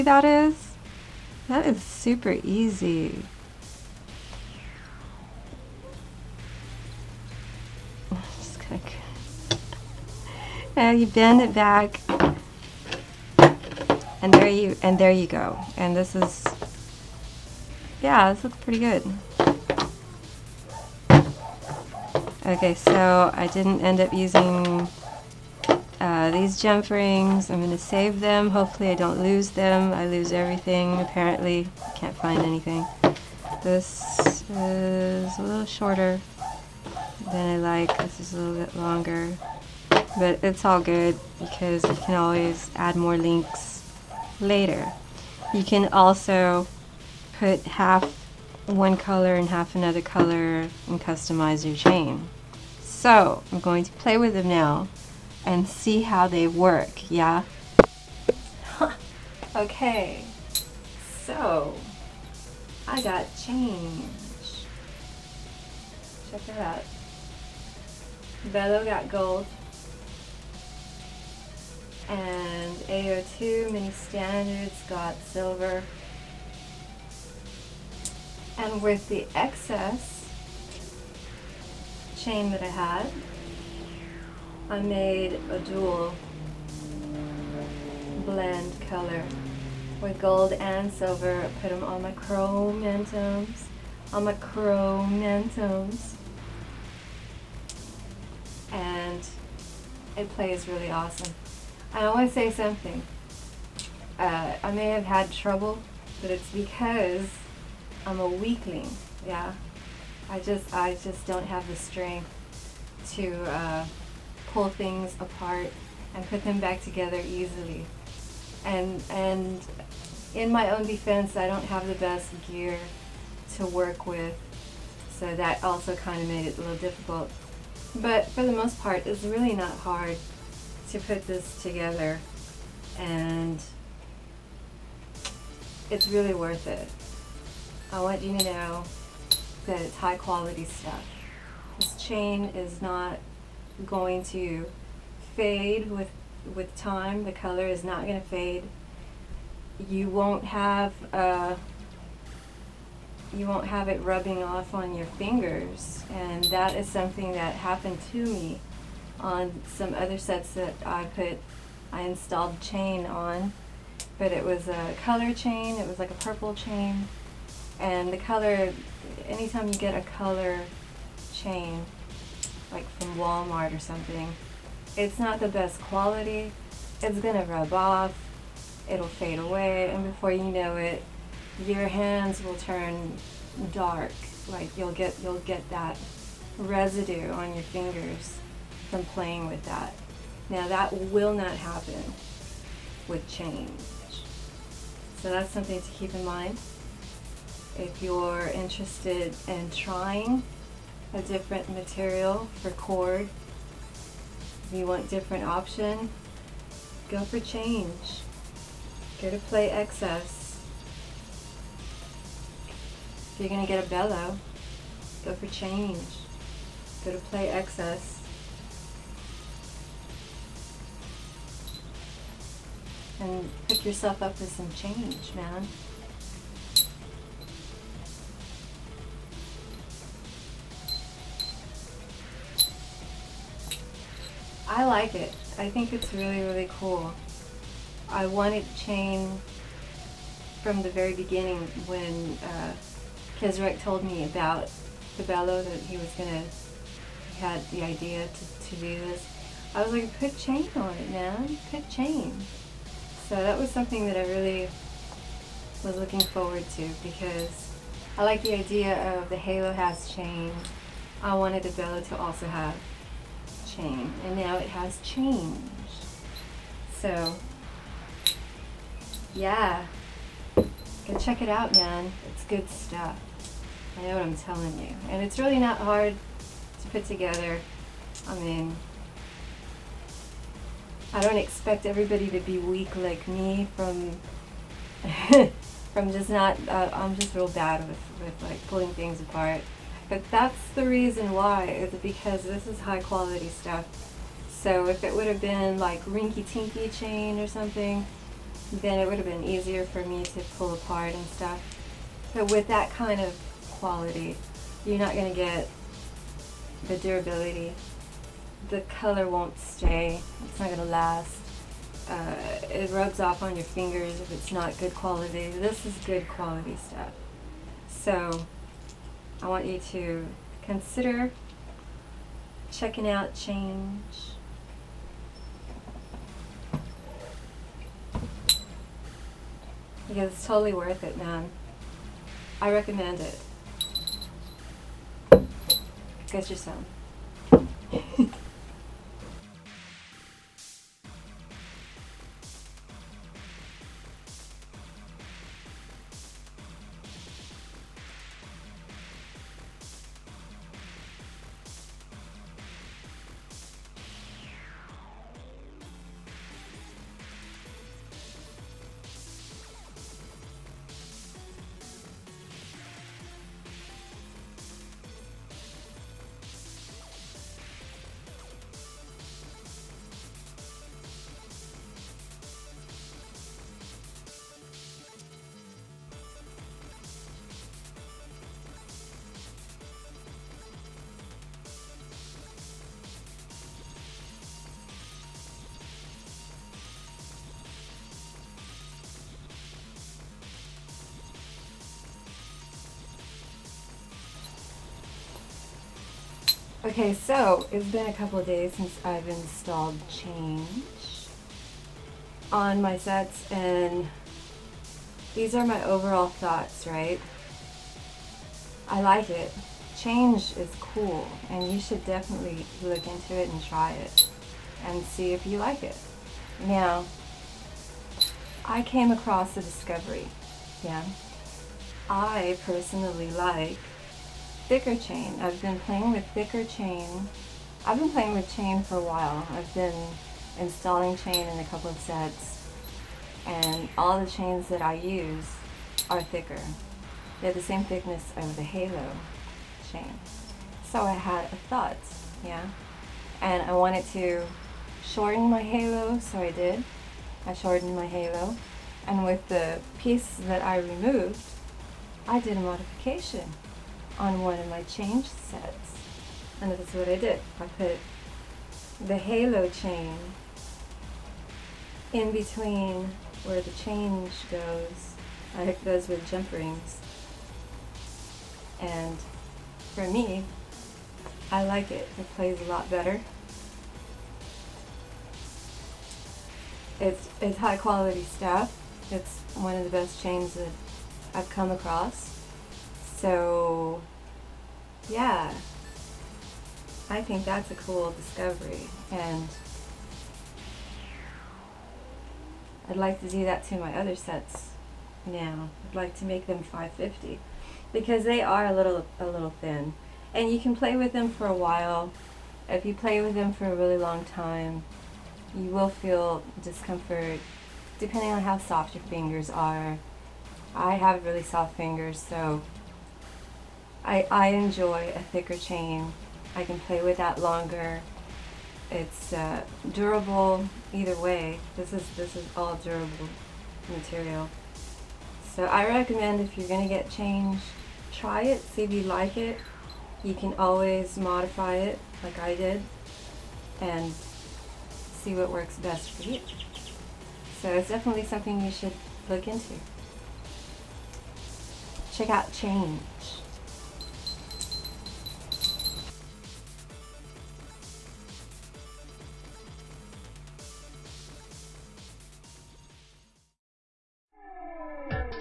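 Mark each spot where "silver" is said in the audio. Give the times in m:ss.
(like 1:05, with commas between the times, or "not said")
1:15, 1:30.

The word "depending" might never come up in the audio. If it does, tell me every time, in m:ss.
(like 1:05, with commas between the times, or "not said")
8:27.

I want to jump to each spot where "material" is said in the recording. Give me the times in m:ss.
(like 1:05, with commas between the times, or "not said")
3:21, 8:43.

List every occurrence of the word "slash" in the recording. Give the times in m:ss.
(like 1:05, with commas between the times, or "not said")
not said.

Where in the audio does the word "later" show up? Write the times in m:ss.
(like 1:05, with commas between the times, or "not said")
0:44.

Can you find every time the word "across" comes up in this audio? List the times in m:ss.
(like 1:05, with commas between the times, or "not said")
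6:59, 8:01.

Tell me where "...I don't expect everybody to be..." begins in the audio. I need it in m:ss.
4:41.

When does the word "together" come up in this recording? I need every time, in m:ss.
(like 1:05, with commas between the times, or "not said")
1:56, 2:11, 4:37.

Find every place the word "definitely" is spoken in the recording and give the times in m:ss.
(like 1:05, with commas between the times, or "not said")
6:52, 8:57.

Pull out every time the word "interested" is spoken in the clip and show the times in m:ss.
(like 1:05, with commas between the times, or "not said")
3:18.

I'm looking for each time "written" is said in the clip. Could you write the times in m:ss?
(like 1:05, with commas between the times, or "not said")
not said.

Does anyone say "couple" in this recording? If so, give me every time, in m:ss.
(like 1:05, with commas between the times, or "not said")
6:38, 7:11.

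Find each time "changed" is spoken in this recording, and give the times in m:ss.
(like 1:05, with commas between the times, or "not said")
4:25, 8:47.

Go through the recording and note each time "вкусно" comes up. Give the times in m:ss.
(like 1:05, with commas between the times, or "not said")
not said.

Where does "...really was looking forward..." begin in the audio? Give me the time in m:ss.
4:14.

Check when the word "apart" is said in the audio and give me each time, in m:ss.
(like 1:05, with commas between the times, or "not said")
1:55, 4:49, 5:00.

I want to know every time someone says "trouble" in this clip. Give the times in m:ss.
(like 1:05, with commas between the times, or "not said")
1:45.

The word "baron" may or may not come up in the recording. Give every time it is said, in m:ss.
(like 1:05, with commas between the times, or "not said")
not said.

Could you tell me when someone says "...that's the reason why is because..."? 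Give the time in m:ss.
4:50.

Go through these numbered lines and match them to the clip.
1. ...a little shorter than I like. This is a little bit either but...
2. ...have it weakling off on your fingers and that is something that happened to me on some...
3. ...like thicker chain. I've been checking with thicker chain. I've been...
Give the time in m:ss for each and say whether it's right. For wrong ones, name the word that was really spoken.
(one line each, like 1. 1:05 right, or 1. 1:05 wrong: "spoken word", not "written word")
1. 0:35 wrong: "longer", not "either"
2. 2:33 wrong: "rubbing", not "weakling"
3. 7:03 wrong: "playing", not "checking".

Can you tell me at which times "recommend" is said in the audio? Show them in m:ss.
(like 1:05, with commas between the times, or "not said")
5:32, 8:45.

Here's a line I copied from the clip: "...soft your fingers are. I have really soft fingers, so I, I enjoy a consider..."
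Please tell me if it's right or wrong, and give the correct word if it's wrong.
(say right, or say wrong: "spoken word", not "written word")
wrong: "thicker", not "consider".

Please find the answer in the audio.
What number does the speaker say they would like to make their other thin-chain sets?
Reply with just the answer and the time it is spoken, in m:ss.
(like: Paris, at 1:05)
550, at 8:16.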